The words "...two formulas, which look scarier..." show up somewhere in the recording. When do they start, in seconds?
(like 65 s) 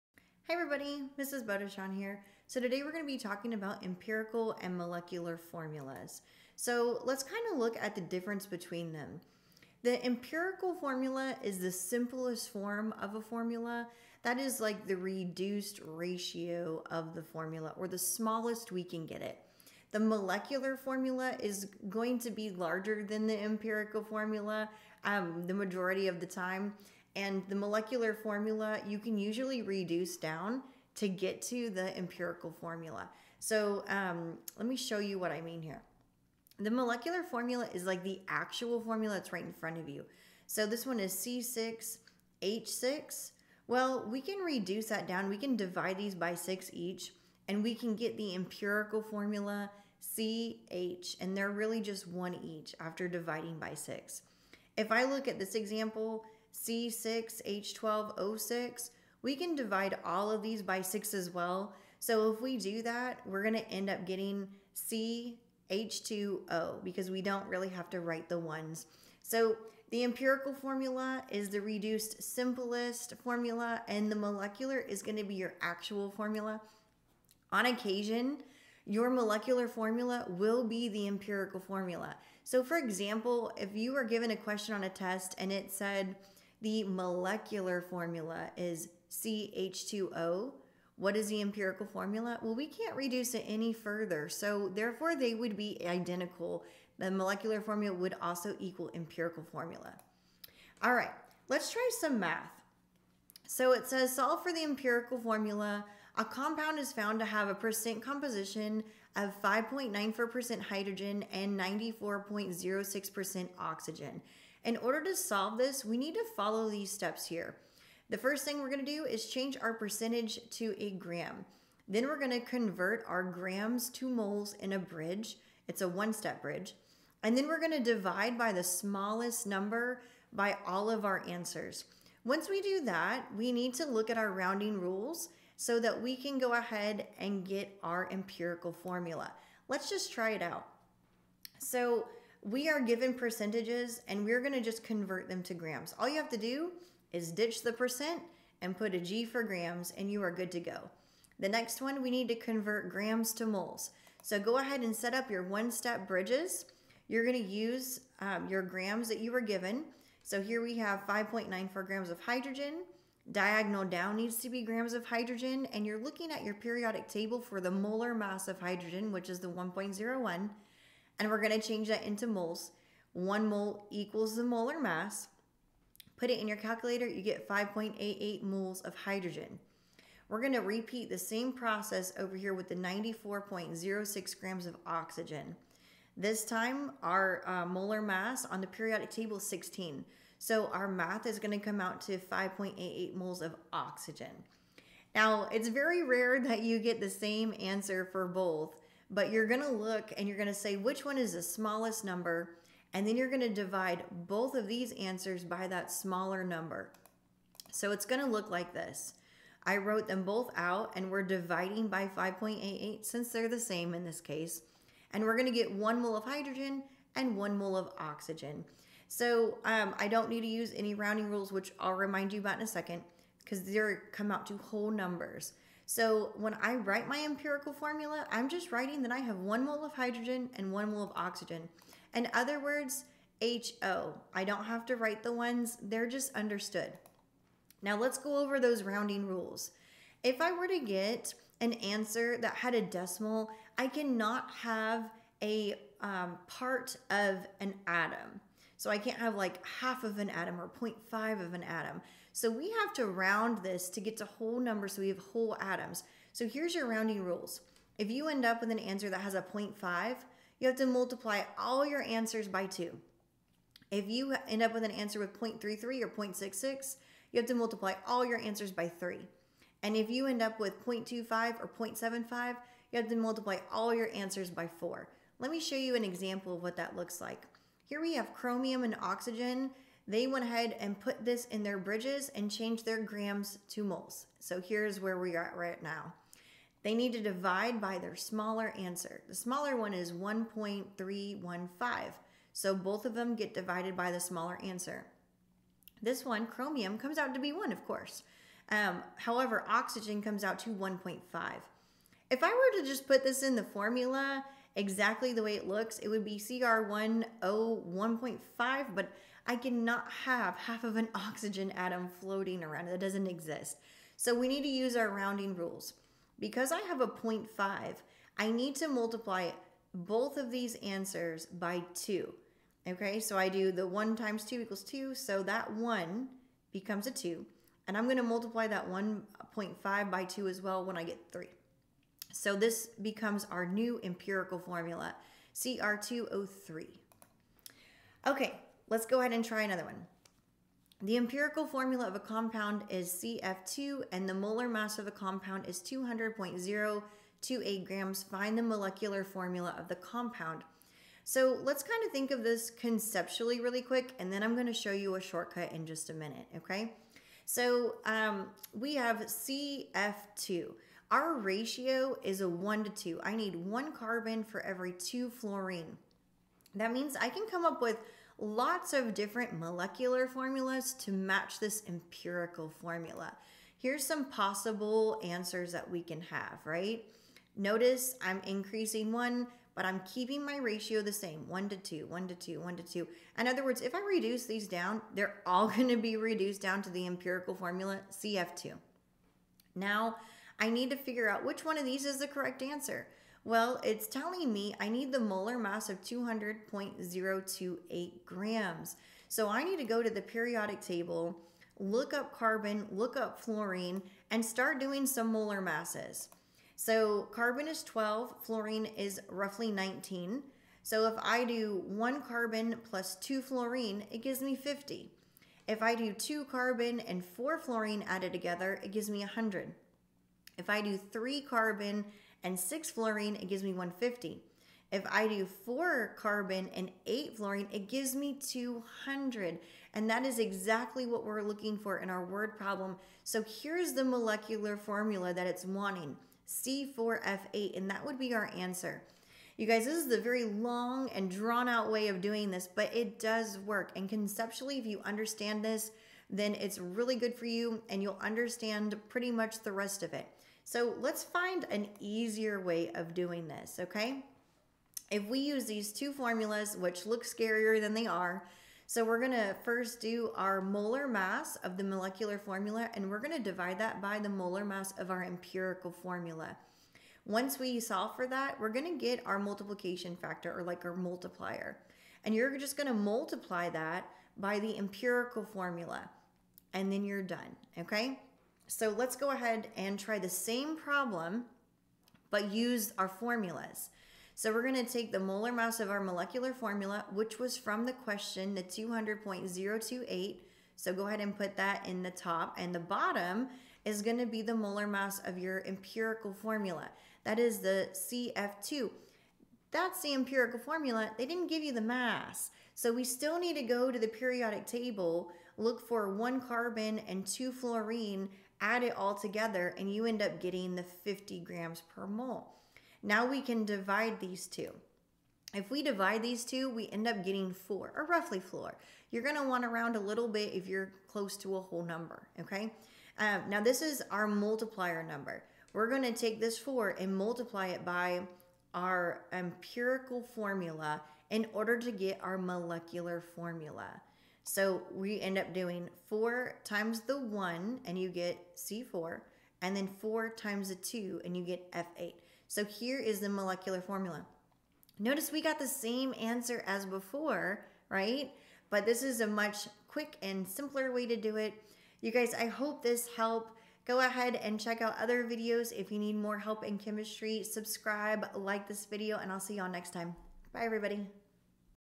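455 s.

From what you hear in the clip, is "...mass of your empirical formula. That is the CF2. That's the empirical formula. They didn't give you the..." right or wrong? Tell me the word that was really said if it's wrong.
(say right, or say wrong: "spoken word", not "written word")
right.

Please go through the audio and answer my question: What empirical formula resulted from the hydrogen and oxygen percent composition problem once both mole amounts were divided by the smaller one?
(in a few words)
HO.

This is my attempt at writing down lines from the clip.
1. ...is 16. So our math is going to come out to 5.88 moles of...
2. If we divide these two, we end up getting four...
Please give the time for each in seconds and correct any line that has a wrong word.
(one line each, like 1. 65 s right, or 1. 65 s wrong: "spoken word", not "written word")
1. 189 s right
2. 515 s right.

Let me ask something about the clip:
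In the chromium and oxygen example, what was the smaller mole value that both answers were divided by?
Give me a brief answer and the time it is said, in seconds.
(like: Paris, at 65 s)
1.315, at 290 s.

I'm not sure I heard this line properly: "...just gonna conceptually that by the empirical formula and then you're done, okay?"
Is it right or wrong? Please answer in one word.
wrong.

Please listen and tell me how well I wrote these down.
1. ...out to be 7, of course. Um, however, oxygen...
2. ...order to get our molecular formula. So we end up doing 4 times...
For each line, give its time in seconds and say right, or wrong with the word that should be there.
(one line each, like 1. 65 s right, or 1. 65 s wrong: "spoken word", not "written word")
1. 297 s wrong: "1", not "7"
2. 531 s right.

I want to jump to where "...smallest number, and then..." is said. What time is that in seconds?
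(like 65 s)
201 s.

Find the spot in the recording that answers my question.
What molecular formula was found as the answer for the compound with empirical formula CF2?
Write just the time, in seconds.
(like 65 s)
436 s.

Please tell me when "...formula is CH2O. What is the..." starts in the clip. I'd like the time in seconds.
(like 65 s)
87 s.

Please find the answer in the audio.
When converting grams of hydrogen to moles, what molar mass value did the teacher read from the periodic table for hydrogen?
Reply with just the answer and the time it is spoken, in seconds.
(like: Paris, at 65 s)
1.01, at 169 s.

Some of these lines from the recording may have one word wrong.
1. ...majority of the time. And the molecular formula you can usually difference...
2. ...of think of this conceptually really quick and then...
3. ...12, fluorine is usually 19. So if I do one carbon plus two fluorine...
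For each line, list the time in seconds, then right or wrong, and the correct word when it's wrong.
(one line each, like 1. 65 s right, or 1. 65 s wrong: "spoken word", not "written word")
1. 25 s wrong: "reduce", not "difference"
2. 352 s right
3. 407 s wrong: "roughly", not "usually".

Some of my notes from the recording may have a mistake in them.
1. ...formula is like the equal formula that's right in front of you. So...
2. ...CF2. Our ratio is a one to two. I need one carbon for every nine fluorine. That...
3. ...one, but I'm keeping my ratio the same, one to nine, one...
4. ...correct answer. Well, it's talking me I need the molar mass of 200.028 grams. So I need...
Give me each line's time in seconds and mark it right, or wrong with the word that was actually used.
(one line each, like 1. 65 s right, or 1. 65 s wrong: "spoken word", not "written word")
1. 37 s wrong: "actual", not "equal"
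2. 359 s wrong: "two", not "nine"
3. 379 s wrong: "two", not "nine"
4. 392 s wrong: "telling", not "talking".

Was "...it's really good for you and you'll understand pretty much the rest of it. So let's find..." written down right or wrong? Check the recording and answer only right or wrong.
right.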